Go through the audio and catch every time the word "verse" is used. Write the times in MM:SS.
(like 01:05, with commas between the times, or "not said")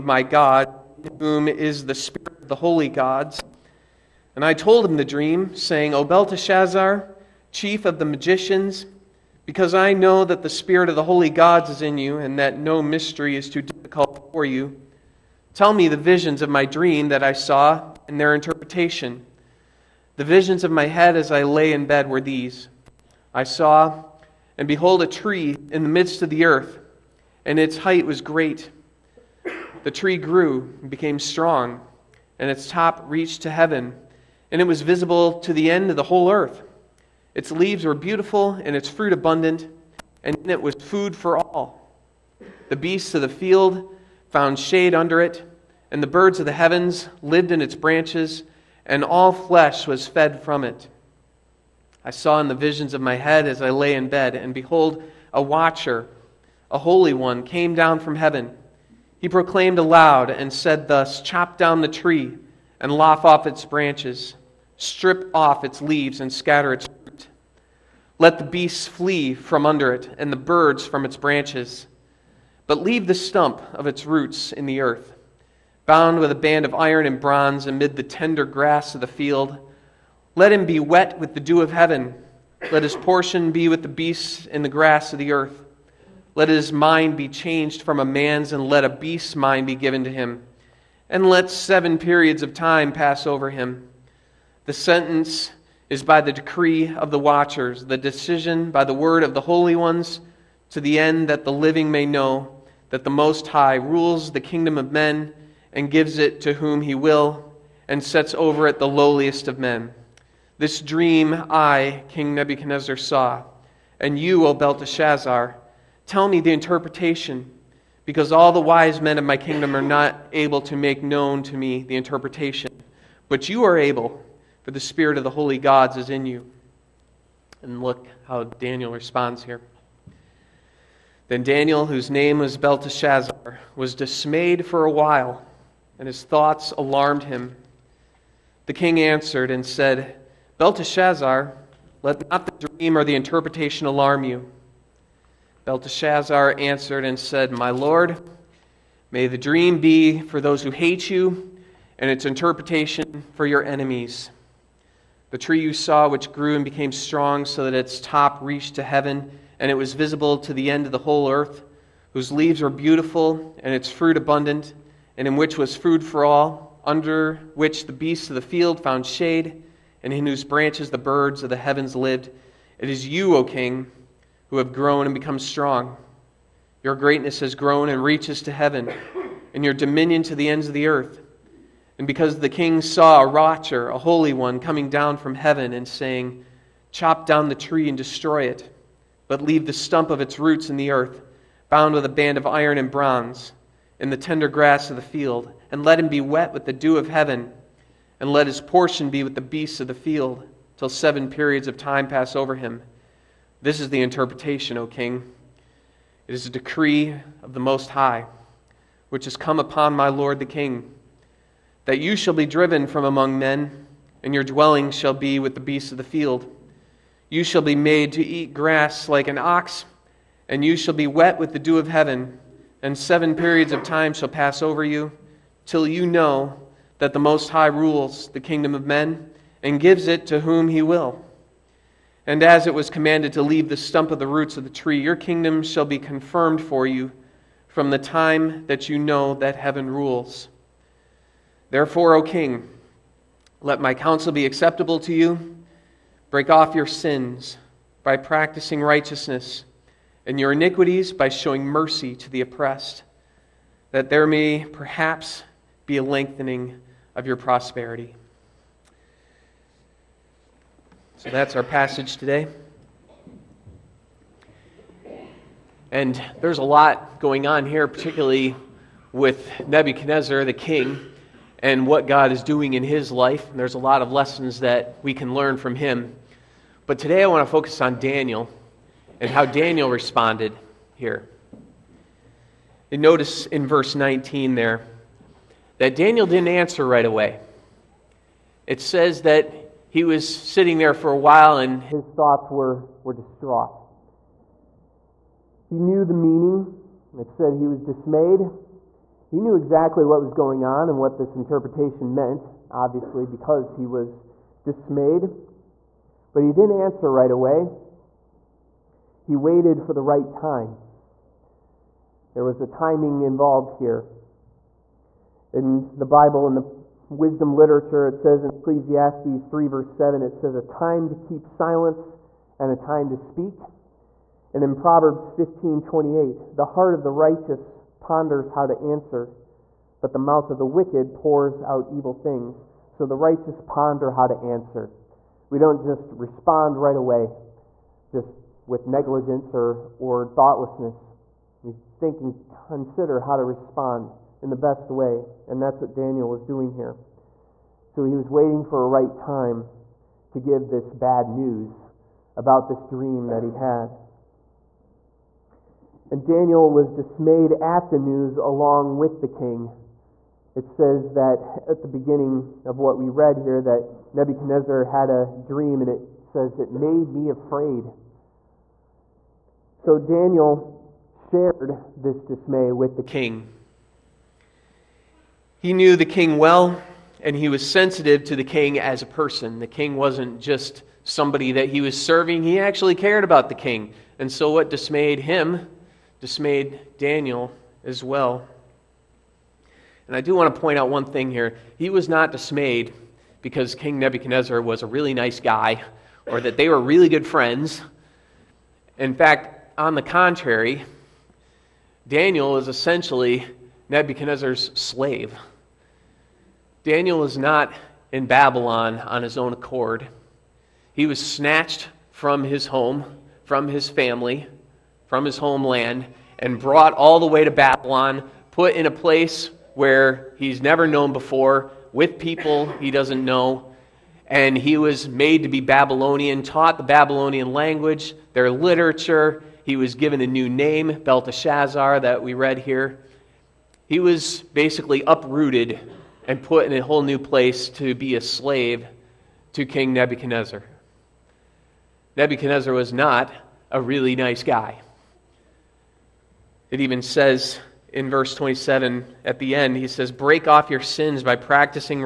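04:43, 05:19, 07:28.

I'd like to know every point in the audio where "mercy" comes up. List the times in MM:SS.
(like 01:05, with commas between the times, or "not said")
04:11.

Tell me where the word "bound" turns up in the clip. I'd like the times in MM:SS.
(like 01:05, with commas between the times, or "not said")
01:15, 03:11.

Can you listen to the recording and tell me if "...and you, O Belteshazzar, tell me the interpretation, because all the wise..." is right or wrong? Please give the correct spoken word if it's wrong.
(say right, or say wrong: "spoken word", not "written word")
right.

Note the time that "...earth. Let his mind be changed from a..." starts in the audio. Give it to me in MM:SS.
01:25.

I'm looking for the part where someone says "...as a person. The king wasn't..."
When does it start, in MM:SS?
06:18.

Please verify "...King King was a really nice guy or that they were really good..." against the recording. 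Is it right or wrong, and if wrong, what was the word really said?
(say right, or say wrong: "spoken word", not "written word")
wrong: "Nebuchadnezzar", not "King".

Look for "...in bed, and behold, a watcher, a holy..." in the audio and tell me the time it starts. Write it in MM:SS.
00:53.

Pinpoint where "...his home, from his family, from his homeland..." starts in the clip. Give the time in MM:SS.
06:52.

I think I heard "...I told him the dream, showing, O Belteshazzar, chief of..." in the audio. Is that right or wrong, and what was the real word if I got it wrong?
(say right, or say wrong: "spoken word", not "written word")
wrong: "saying", not "showing".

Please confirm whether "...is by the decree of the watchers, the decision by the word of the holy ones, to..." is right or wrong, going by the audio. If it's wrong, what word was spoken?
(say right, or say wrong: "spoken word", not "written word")
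right.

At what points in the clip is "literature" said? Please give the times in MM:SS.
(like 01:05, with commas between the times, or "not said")
05:17, 07:08.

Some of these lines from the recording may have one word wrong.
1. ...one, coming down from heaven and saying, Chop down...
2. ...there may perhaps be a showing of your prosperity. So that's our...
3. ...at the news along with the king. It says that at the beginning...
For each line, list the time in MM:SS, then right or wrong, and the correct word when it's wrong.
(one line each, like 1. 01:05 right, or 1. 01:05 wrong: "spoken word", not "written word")
1. 03:04 right
2. 04:14 wrong: "lengthening", not "showing"
3. 05:57 right.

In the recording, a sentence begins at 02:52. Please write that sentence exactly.
It is you, O king, who have grown and become strong.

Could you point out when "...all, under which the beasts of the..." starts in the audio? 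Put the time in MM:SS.
02:46.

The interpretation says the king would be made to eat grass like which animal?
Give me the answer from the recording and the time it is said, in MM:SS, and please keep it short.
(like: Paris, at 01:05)
an ox, at 03:39.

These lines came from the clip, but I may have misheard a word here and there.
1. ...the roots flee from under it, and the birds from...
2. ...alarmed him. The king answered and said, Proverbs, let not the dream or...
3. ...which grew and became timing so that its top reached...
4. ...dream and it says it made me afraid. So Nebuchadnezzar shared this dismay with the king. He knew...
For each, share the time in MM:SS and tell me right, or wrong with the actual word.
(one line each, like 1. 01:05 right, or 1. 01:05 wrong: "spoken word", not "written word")
1. 01:08 wrong: "beasts", not "roots"
2. 02:16 wrong: "Belteshazzar", not "Proverbs"
3. 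02:36 wrong: "strong", not "timing"
4. 06:05 wrong: "Daniel", not "Nebuchadnezzar".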